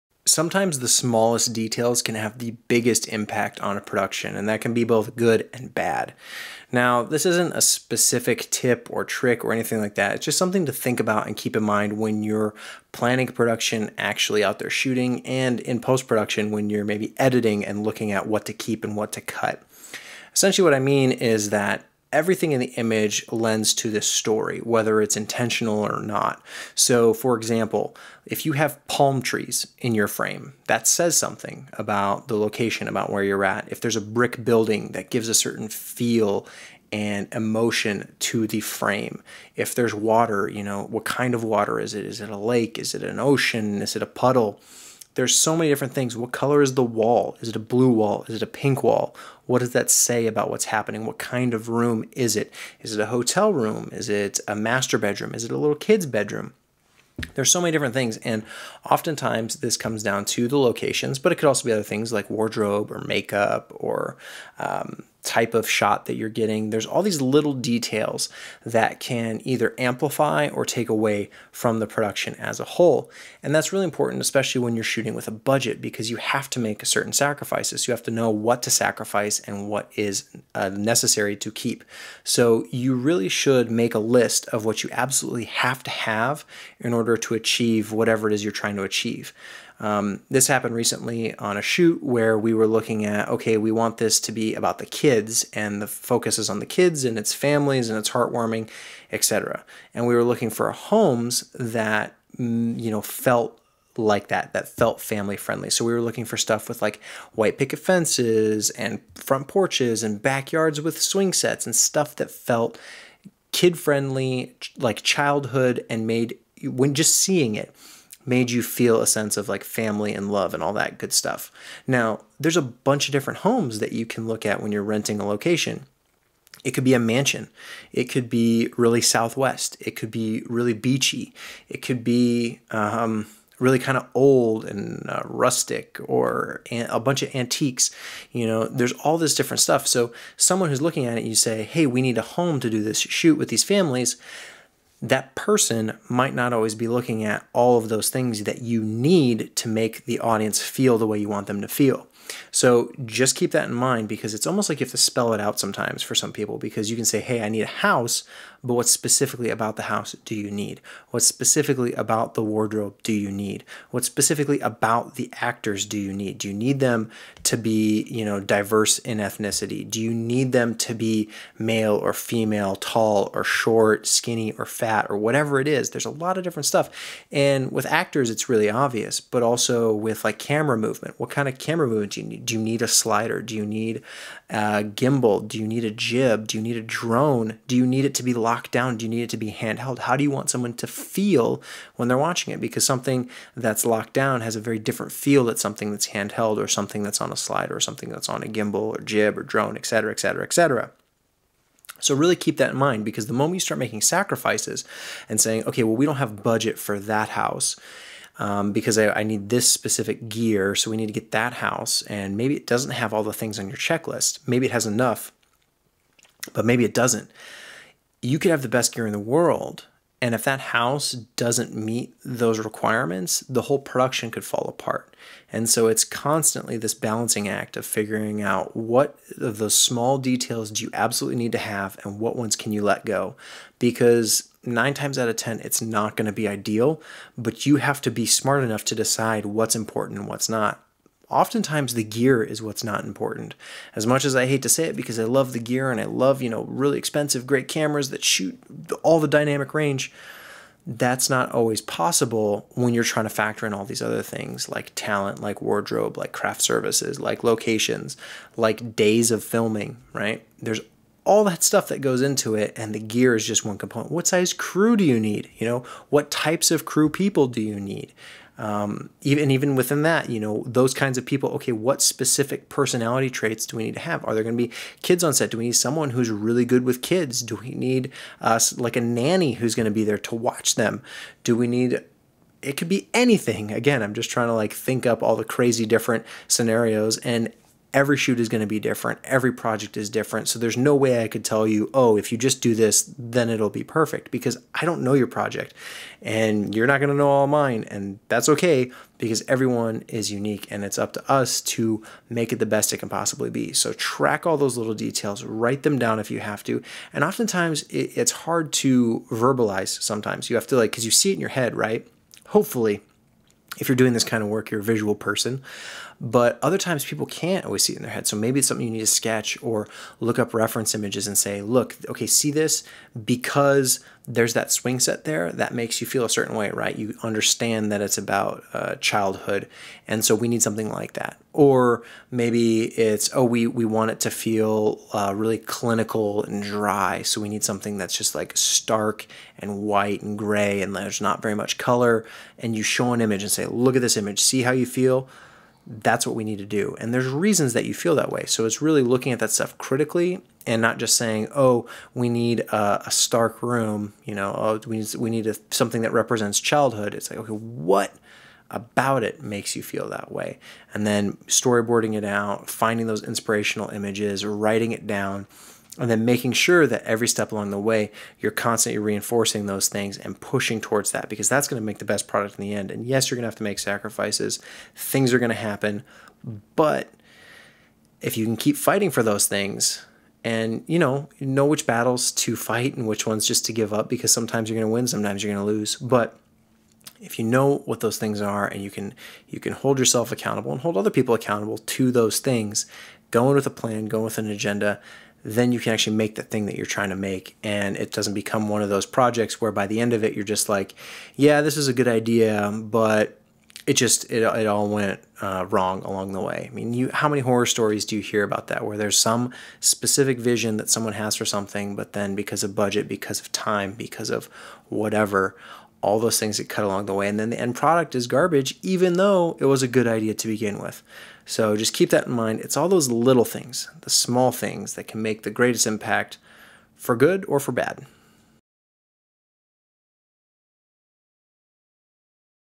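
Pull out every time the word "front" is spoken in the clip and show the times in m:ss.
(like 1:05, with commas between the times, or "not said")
1:49.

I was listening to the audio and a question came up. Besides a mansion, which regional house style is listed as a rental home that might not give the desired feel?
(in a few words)
Southwest.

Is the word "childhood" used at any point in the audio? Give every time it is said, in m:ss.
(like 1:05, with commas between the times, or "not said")
1:55, 5:28, 5:56.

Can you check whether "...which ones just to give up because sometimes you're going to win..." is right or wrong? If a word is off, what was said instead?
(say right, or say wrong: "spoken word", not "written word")
right.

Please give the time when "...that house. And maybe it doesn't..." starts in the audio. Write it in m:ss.
3:31.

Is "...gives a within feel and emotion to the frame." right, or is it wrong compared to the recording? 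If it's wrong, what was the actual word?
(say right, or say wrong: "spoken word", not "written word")
wrong: "certain", not "within".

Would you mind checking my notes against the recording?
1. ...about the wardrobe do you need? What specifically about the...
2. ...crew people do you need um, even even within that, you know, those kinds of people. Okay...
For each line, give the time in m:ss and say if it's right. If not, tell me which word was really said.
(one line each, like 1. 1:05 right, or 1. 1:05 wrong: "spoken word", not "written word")
1. 2:41 right
2. 4:26 right.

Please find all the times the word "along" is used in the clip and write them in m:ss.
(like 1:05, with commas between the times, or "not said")
6:07, 6:46, 6:56.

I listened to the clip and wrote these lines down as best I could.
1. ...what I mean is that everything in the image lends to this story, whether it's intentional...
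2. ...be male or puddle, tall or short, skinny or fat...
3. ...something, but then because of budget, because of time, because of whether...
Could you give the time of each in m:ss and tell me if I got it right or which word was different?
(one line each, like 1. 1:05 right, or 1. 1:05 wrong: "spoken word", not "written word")
1. 0:20 right
2. 2:50 wrong: "female", not "puddle"
3. 6:51 wrong: "whatever", not "whether".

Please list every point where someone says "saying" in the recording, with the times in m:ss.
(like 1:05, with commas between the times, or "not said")
3:25, 5:51.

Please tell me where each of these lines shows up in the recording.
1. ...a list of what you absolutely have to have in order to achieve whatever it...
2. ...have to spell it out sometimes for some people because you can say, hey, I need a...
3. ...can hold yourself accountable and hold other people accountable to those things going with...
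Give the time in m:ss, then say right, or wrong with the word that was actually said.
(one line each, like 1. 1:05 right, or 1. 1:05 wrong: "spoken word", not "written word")
1. 1:23 right
2. 2:34 right
3. 6:29 right.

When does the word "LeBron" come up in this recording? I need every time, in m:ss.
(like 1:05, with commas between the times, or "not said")
not said.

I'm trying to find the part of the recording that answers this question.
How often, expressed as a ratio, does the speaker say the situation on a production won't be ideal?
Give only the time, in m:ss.
3:54.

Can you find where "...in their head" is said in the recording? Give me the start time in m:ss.
5:17.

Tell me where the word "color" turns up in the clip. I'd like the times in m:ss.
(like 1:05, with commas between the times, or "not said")
0:46, 5:41.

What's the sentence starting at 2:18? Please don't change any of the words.
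You know, there's all this different stuff.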